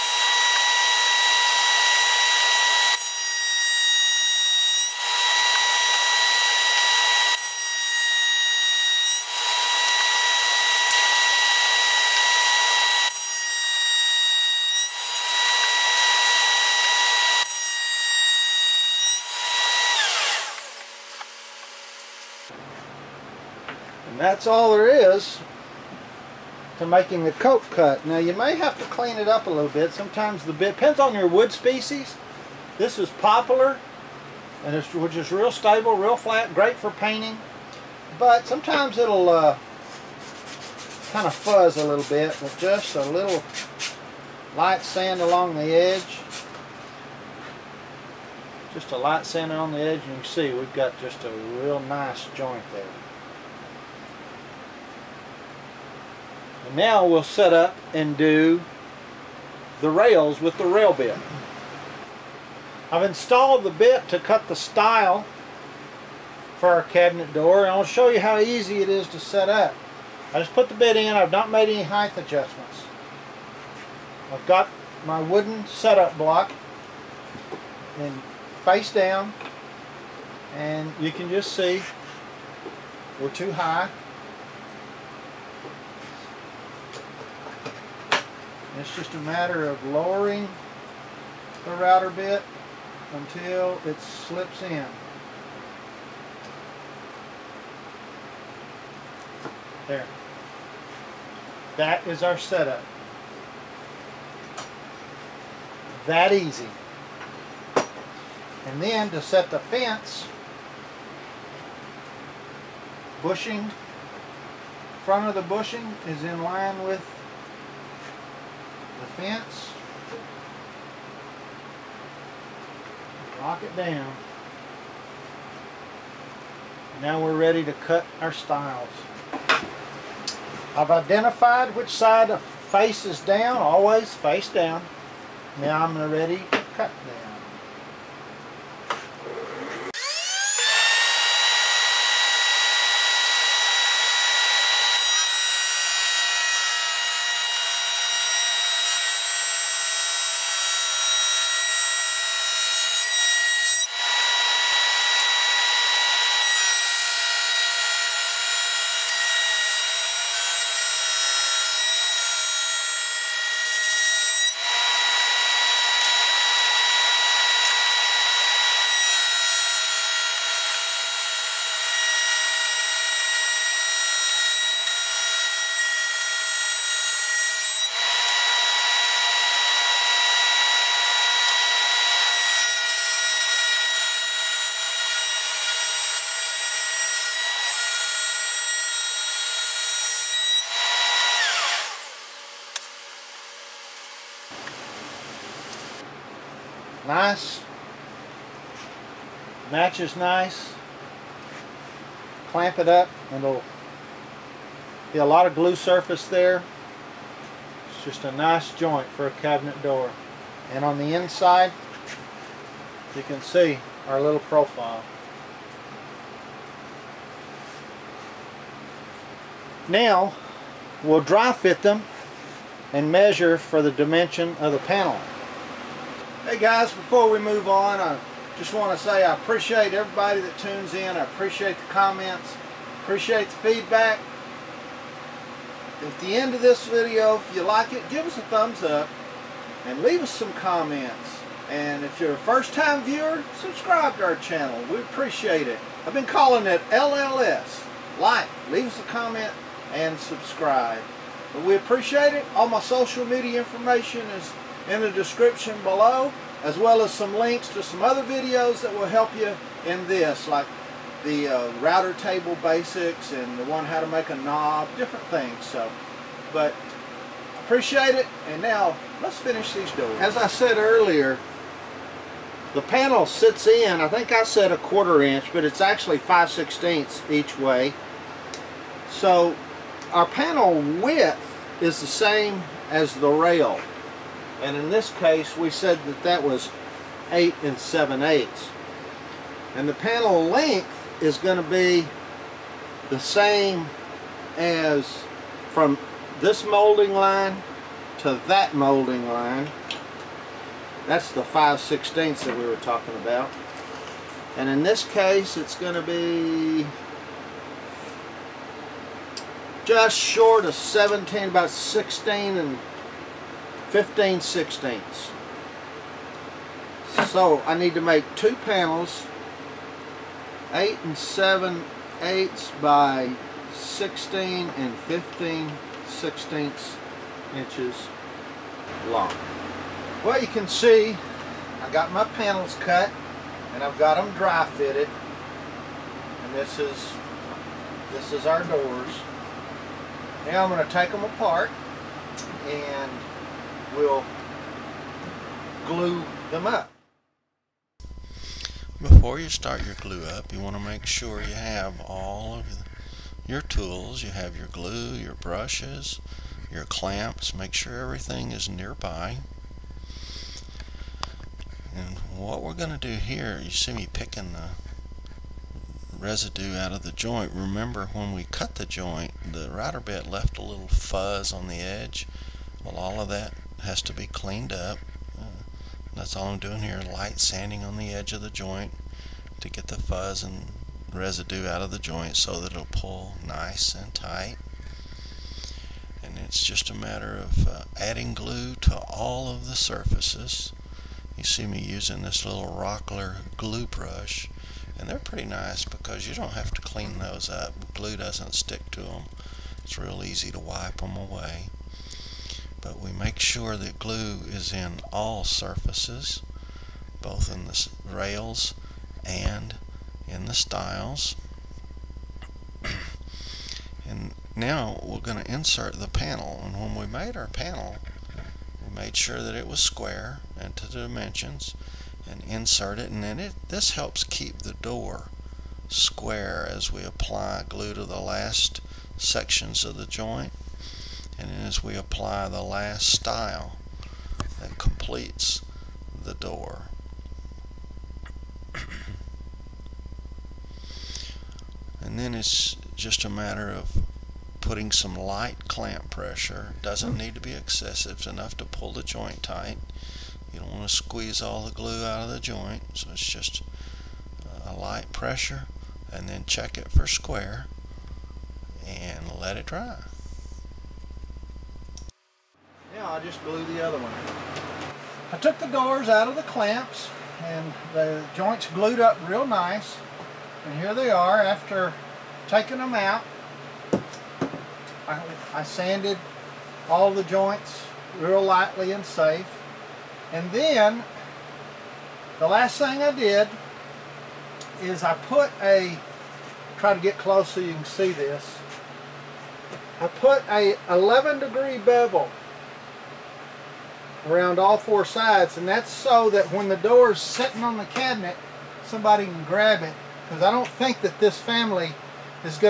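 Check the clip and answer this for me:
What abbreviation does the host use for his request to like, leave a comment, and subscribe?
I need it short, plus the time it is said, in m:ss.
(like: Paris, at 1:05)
LLS, at 4:06.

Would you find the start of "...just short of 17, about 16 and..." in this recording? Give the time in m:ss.
5:09.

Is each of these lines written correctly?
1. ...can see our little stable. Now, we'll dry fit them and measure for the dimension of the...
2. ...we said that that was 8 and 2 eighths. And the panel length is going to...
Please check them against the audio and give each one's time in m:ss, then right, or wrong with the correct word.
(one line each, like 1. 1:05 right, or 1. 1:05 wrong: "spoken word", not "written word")
1. 3:33 wrong: "profile", not "stable"
2. 4:45 wrong: "7", not "2".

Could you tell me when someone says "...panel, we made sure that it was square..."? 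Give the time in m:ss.
6:57.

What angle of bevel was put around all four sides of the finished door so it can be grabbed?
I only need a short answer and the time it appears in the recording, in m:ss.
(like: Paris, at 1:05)
11 degrees, at 8:10.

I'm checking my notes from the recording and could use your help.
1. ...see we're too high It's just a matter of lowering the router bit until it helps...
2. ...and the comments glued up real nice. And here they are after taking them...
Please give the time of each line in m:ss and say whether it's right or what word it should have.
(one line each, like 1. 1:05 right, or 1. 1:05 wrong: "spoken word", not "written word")
1. 1:21 wrong: "slips", not "helps"
2. 7:47 wrong: "joints", not "comments".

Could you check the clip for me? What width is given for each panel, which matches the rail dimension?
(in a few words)
8 7/8 inches.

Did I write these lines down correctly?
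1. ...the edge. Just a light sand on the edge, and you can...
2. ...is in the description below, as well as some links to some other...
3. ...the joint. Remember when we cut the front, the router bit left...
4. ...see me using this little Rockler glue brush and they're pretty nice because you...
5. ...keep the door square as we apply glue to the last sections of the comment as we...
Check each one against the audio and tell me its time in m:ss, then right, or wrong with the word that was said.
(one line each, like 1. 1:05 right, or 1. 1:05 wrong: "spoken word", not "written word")
1. 0:45 right
2. 4:14 right
3. 6:07 wrong: "joint", not "front"
4. 6:31 right
5. 7:04 wrong: "joint", not "comment".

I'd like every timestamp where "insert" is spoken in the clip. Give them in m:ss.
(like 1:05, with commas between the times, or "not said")
6:55, 7:02.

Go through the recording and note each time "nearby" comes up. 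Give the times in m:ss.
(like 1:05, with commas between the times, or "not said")
5:58.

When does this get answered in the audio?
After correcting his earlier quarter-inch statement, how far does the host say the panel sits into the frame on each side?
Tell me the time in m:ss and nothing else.
4:36.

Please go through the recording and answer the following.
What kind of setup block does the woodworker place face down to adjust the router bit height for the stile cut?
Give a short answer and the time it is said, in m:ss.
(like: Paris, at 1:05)
Wooden setup block, at 1:15.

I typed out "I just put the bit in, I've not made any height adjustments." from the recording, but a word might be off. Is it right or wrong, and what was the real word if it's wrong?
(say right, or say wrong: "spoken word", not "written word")
right.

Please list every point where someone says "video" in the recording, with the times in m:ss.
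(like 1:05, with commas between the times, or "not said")
3:56, 4:18.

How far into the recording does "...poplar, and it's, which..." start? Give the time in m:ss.
0:33.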